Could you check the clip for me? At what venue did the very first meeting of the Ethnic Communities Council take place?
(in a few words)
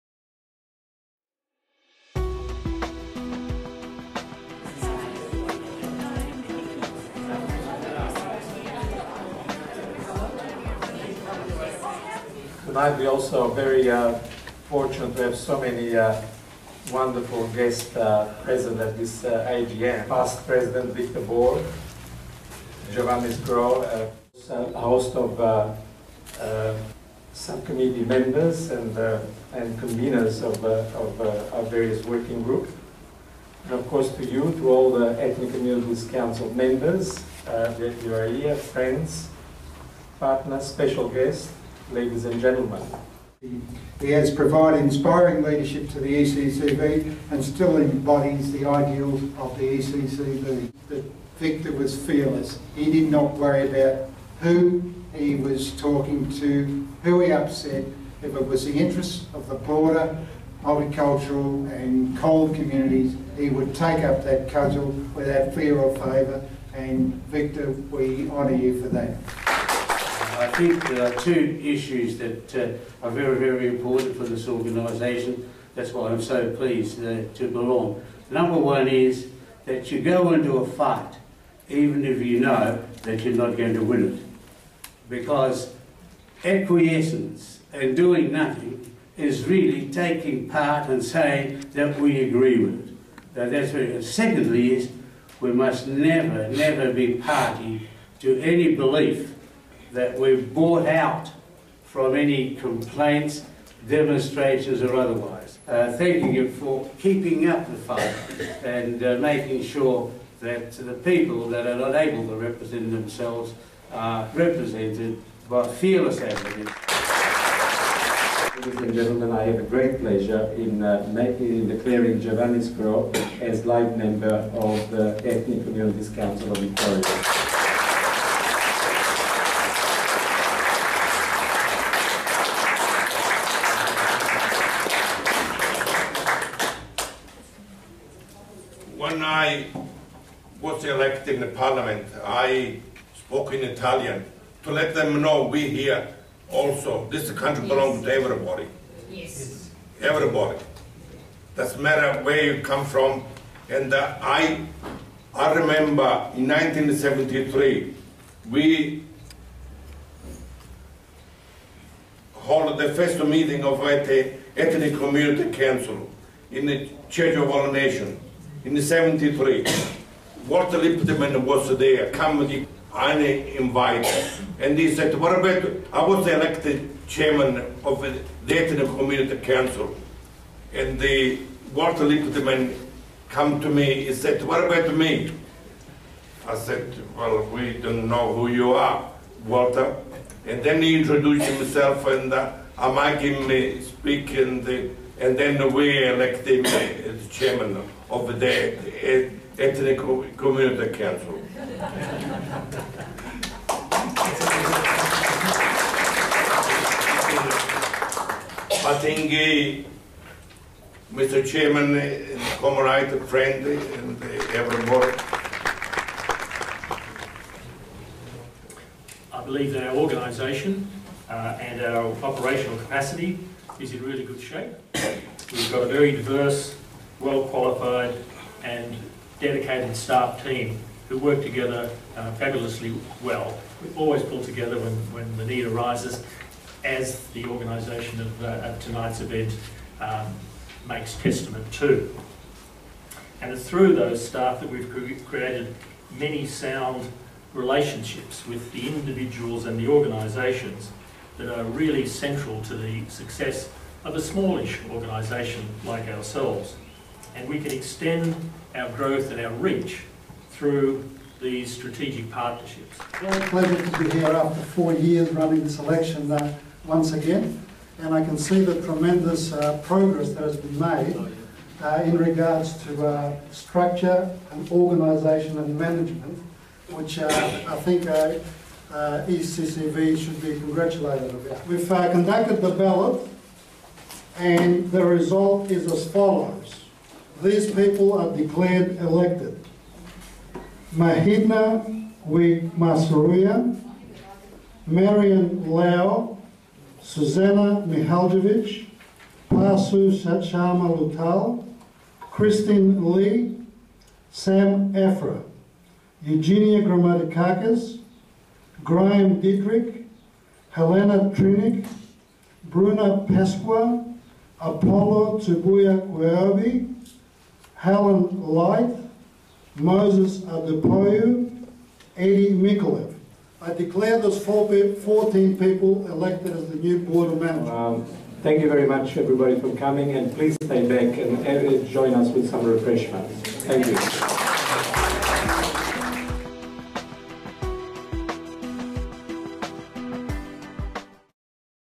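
Church of All Nations.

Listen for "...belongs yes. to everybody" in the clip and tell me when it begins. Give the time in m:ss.
2:27.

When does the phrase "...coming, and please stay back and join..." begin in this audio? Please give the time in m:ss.
5:29.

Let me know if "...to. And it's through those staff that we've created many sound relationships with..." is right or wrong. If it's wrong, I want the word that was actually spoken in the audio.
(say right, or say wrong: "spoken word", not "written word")
right.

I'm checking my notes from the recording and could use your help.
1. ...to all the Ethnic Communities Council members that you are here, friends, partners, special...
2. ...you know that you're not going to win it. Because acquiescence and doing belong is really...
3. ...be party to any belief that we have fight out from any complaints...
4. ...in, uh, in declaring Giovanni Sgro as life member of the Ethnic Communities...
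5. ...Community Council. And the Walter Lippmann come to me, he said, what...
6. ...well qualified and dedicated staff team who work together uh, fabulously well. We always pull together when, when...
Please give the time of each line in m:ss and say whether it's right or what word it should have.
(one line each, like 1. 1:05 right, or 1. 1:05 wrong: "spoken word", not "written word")
1. 0:34 right
2. 1:22 wrong: "nothing", not "belong"
3. 1:36 wrong: "bought", not "fight"
4. 2:00 right
5. 2:58 right
6. 3:47 right.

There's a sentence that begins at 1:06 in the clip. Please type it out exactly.
And Victor, we honour you for that.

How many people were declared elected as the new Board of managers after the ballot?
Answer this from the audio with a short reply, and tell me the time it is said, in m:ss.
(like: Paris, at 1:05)
14, at 5:24.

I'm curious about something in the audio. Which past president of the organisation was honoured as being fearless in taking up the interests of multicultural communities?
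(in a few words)
Victor Bohr.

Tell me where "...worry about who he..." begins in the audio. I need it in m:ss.
0:53.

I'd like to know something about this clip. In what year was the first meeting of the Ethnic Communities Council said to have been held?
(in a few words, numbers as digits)
1973.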